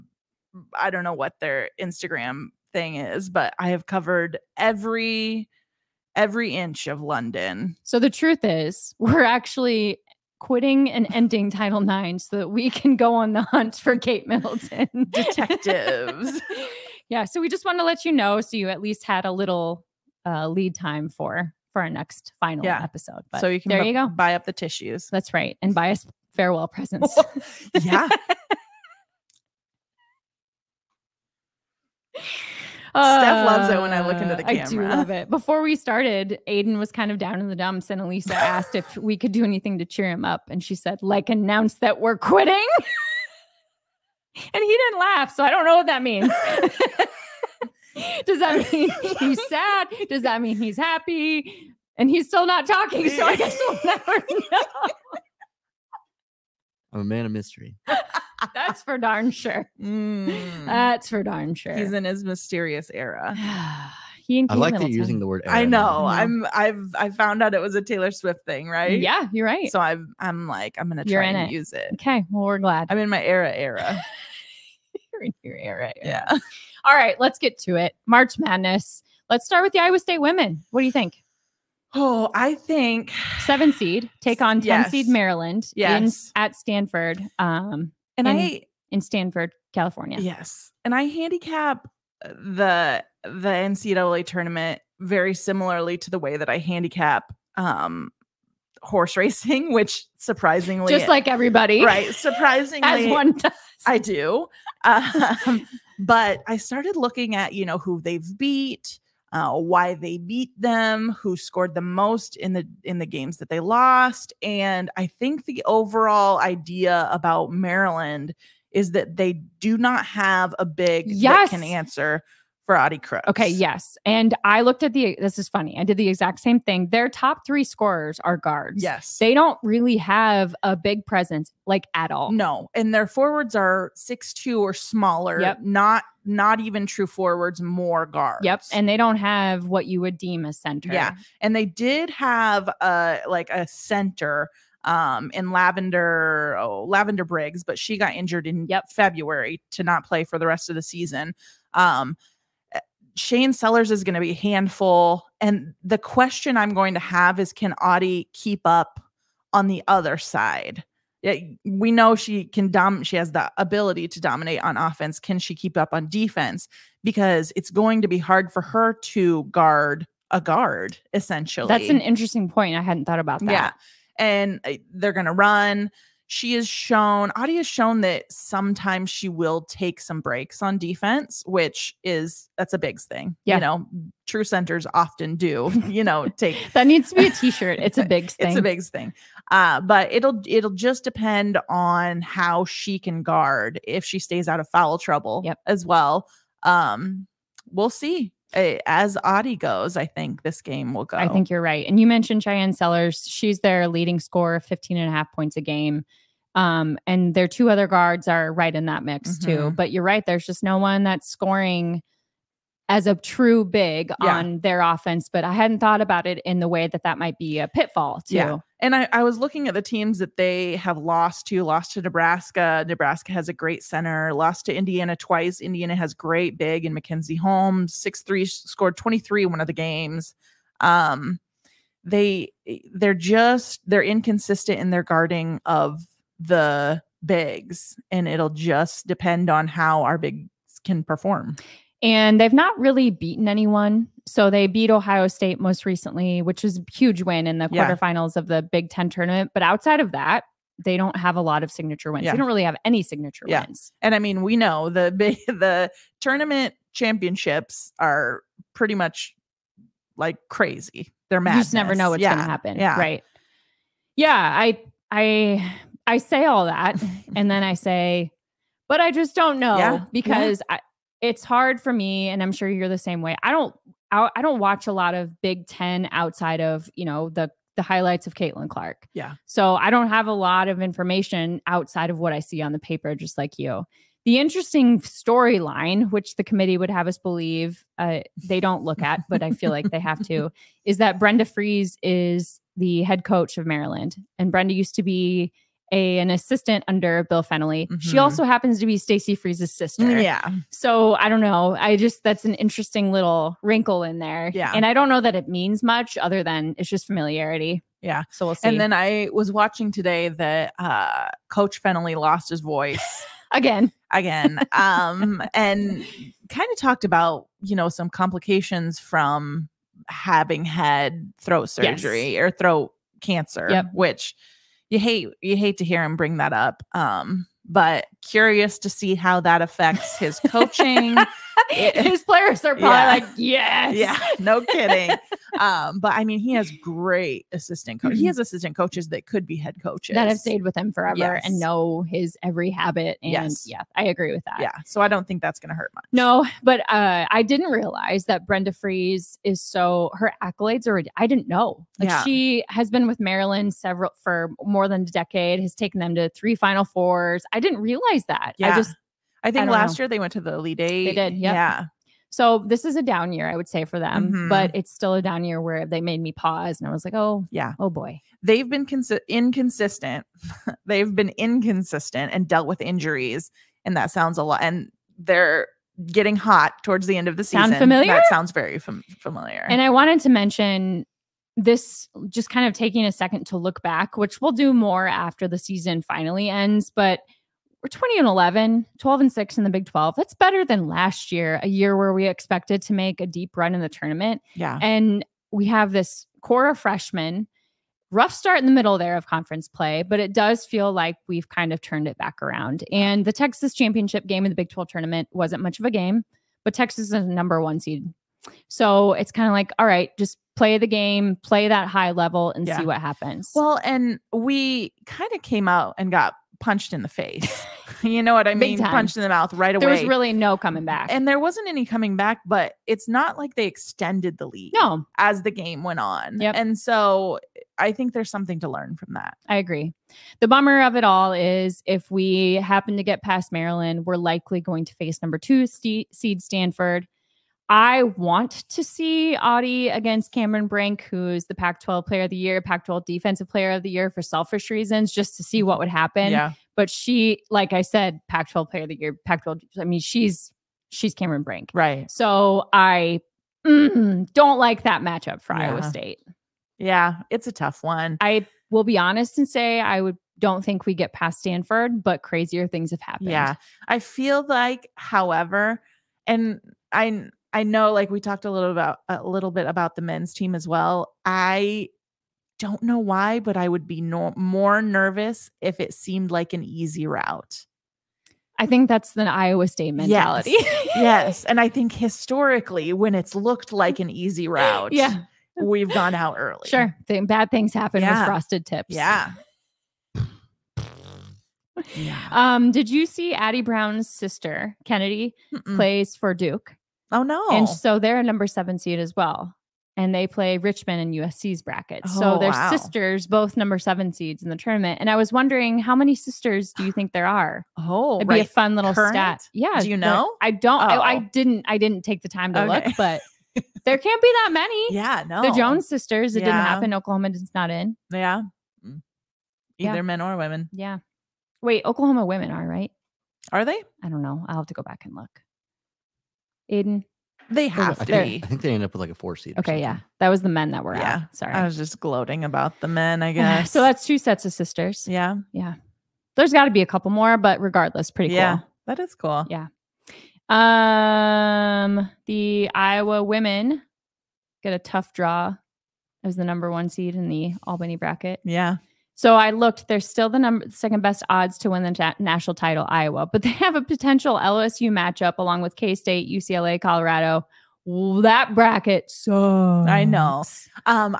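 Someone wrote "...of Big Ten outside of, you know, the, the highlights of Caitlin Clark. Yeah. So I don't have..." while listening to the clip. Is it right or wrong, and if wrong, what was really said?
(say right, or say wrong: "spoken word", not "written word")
right.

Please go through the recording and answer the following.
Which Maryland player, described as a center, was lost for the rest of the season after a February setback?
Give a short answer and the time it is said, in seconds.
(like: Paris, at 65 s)
Lavender Briggs, at 146 s.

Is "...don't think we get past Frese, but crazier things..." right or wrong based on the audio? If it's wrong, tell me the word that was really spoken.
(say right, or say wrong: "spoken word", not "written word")
wrong: "Stanford", not "Frese".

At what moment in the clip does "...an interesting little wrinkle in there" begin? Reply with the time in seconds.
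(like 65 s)
302 s.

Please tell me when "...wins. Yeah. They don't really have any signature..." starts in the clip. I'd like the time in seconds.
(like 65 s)
252 s.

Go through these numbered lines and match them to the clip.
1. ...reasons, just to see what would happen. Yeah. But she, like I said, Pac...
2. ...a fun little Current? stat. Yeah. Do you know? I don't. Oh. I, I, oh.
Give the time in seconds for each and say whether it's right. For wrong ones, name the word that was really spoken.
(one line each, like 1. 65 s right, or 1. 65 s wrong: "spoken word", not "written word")
1. 444 s right
2. 508 s right.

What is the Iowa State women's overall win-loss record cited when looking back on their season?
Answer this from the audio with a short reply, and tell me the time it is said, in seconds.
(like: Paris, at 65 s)
20 and 11, at 387 s.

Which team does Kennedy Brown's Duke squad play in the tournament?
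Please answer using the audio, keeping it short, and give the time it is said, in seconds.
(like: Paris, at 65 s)
Richmond, at 500 s.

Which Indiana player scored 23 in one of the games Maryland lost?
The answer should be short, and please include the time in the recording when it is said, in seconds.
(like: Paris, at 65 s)
Mackenzie Holmes, at 226 s.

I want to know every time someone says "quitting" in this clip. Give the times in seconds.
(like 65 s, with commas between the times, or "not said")
10 s, 42 s.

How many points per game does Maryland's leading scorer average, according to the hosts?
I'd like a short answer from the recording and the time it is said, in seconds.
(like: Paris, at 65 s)
15.5, at 204 s.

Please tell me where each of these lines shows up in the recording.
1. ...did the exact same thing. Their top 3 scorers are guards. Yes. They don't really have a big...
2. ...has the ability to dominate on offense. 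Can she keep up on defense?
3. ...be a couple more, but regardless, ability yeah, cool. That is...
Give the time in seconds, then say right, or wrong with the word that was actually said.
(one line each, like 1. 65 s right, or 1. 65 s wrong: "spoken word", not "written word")
1. 125 s right
2. 163 s right
3. 536 s wrong: "pretty", not "ability".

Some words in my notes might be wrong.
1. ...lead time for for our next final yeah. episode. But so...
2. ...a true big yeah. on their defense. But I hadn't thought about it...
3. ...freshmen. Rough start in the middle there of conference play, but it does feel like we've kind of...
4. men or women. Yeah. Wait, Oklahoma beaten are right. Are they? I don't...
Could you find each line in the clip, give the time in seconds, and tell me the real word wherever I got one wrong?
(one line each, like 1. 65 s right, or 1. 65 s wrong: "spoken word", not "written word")
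1. 20 s right
2. 213 s wrong: "offense", not "defense"
3. 396 s right
4. 520 s wrong: "women", not "beaten".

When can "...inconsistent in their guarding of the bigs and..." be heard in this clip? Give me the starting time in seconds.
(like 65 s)
234 s.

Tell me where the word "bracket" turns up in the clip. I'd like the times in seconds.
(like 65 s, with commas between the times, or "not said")
501 s, 547 s, 558 s.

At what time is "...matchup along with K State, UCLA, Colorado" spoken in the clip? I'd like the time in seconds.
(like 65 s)
554 s.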